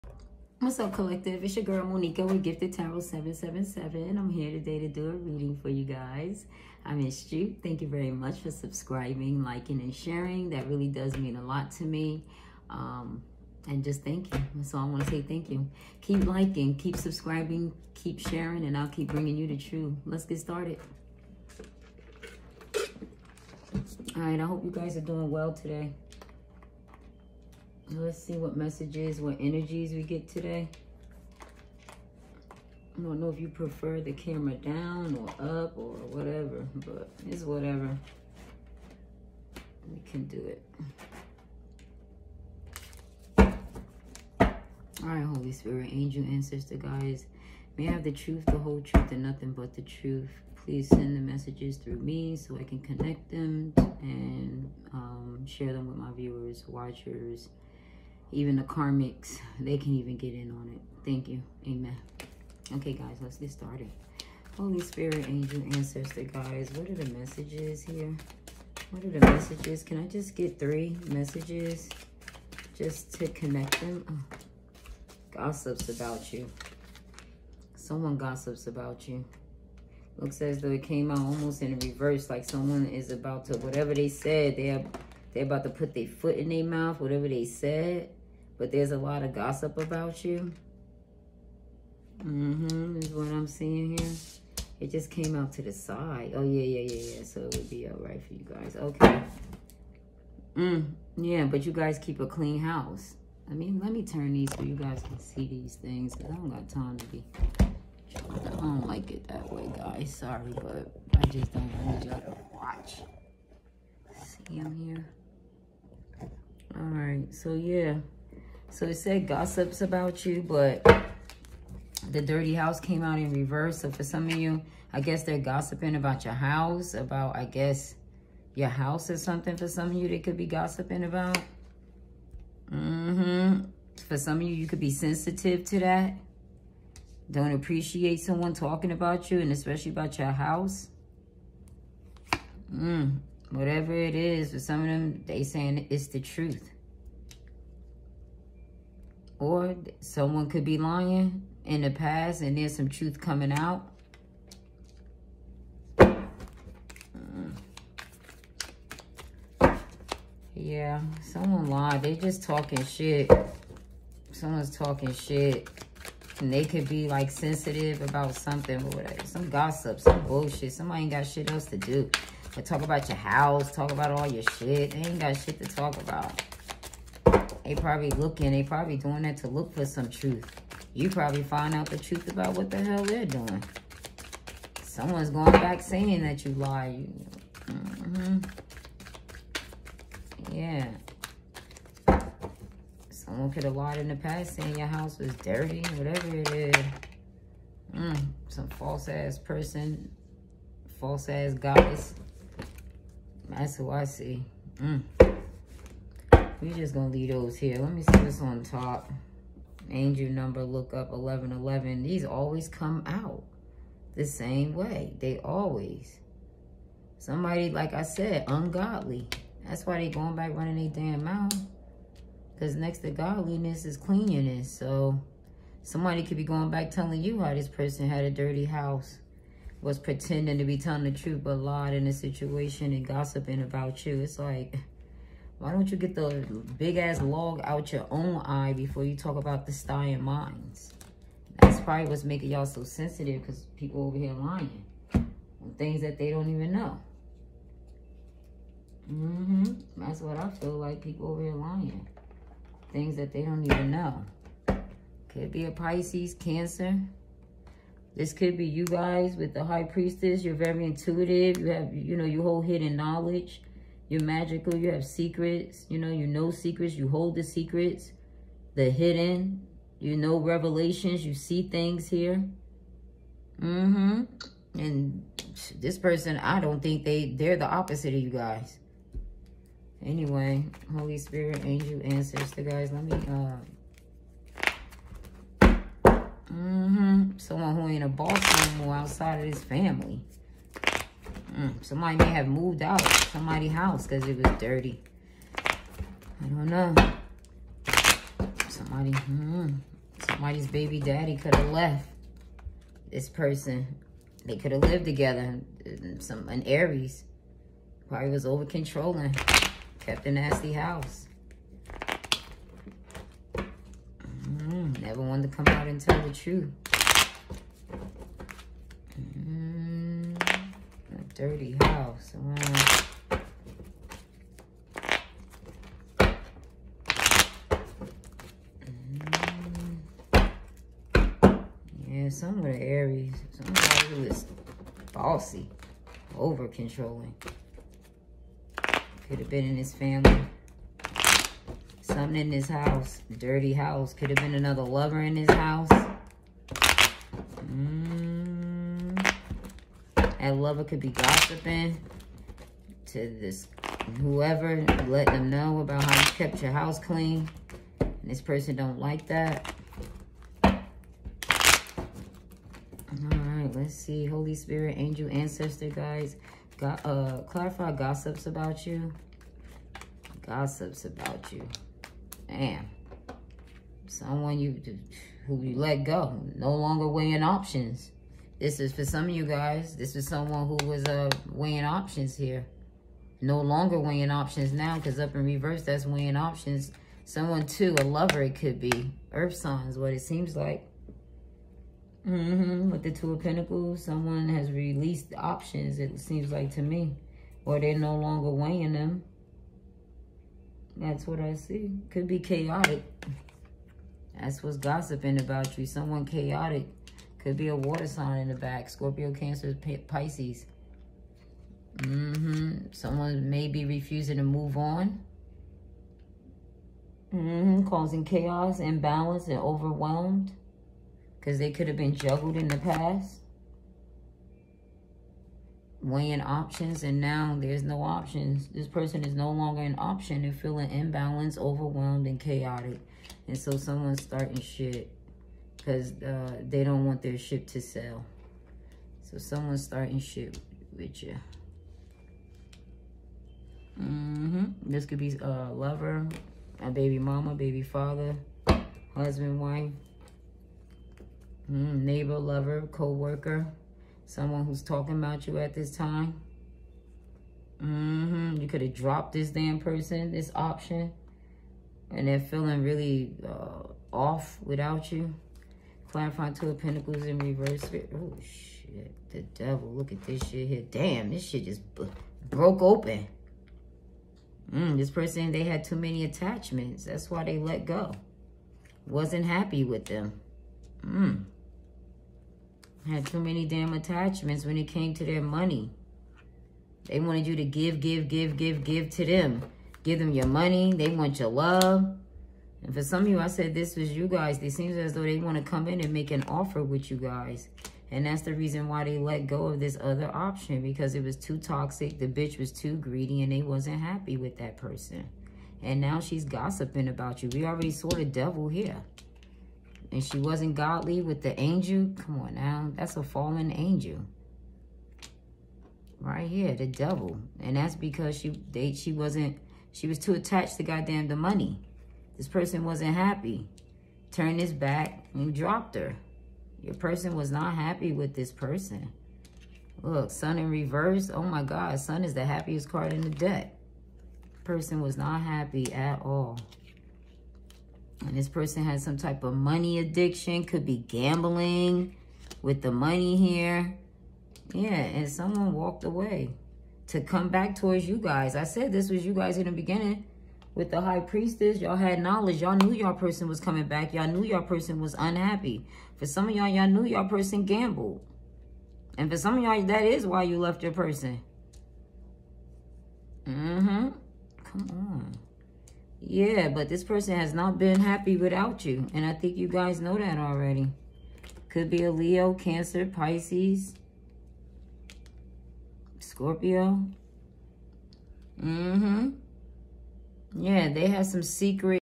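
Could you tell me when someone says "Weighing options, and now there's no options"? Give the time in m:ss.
7:06.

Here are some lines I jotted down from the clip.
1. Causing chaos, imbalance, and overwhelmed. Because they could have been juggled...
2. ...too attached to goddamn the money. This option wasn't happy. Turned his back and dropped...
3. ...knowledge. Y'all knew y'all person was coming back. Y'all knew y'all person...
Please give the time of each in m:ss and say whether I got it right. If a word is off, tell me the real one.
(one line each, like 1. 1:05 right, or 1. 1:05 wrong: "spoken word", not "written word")
1. 6:57 right
2. 8:40 wrong: "person", not "option"
3. 9:12 right.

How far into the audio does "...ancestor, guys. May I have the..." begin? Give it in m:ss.
0:46.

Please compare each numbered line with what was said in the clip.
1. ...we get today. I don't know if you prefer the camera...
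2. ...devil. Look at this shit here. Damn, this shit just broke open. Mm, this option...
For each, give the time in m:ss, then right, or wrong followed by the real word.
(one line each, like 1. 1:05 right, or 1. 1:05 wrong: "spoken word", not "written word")
1. 0:29 right
2. 7:49 wrong: "person", not "option".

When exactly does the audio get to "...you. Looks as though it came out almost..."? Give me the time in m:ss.
1:19.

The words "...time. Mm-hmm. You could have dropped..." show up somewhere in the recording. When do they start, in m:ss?
7:35.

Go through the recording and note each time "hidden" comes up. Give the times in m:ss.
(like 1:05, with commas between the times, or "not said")
4:22, 4:28.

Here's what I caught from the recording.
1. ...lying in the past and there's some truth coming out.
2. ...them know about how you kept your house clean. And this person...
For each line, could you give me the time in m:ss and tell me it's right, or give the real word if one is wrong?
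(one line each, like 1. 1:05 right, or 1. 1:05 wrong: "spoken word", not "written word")
1. 2:30 right
2. 5:55 right.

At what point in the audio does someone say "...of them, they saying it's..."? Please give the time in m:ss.
2:24.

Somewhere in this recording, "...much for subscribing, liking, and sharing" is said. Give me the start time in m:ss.
0:08.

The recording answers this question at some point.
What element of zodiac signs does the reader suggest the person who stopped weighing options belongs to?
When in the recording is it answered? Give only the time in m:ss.
6:29.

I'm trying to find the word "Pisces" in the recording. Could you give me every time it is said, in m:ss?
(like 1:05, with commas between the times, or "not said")
4:15, 6:50, 9:33.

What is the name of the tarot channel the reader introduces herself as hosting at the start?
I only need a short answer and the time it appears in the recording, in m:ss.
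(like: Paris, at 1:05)
Gifted Tarot 777, at 0:02.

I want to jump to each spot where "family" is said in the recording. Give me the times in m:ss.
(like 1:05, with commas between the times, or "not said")
4:49, 5:39.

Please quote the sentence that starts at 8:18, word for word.
And that's the reason why they let go of this other option because it was too toxic.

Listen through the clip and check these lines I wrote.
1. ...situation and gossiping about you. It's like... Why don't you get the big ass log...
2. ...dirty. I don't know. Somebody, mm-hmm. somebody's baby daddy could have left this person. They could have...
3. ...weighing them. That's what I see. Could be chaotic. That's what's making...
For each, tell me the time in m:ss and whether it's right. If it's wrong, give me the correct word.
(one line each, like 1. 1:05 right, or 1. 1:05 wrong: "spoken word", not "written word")
1. 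3:52 right
2. 4:54 right
3. 6:38 wrong: "gossiping", not "making".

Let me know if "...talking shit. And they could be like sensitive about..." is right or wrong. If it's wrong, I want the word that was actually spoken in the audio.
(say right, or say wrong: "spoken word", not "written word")
right.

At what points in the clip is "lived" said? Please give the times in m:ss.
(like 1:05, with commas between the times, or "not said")
5:04.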